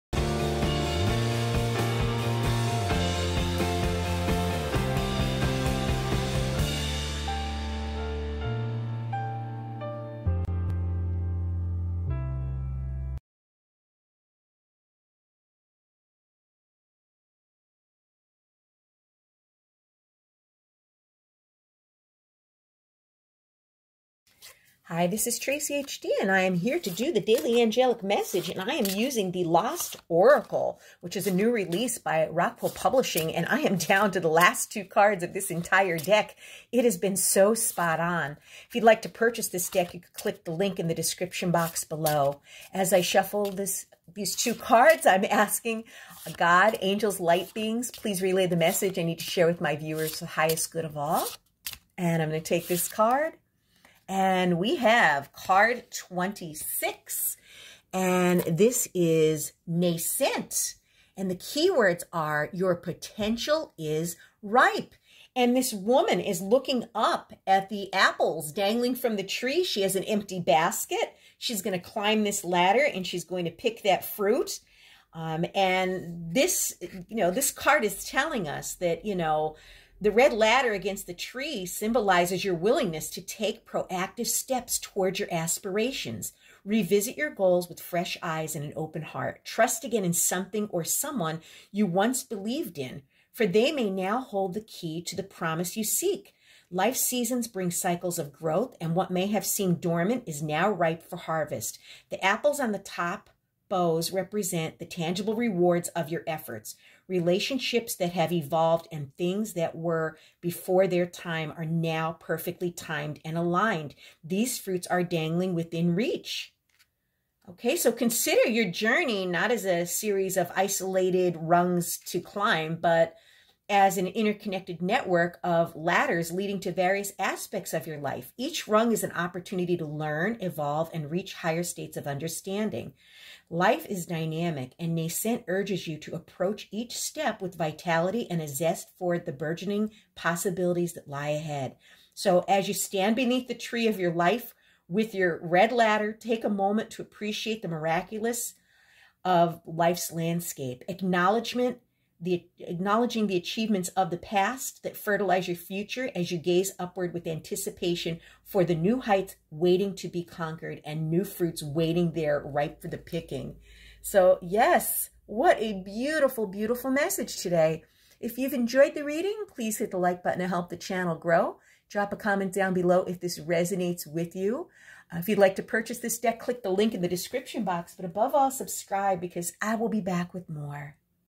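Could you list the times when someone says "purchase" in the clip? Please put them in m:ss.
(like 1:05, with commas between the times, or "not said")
0:39, 2:55.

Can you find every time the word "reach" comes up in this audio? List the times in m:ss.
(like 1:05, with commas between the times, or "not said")
1:55, 2:11.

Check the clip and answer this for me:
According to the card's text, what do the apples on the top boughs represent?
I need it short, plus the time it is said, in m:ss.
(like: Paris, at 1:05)
Tangible rewards of your efforts, at 1:44.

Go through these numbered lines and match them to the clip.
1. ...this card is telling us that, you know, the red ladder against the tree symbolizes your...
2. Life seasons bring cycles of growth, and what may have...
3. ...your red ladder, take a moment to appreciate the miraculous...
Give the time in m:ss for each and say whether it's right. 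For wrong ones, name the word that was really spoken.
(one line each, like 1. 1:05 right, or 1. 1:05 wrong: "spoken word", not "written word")
1. 1:17 right
2. 1:36 right
3. 2:25 right.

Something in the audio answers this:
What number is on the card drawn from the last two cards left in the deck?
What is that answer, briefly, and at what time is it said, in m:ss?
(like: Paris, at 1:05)
26, at 0:55.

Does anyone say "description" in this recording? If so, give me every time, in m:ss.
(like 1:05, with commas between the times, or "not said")
0:40, 2:57.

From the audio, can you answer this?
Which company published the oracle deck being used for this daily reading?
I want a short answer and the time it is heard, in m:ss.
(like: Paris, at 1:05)
Rockpool Publishing, at 0:32.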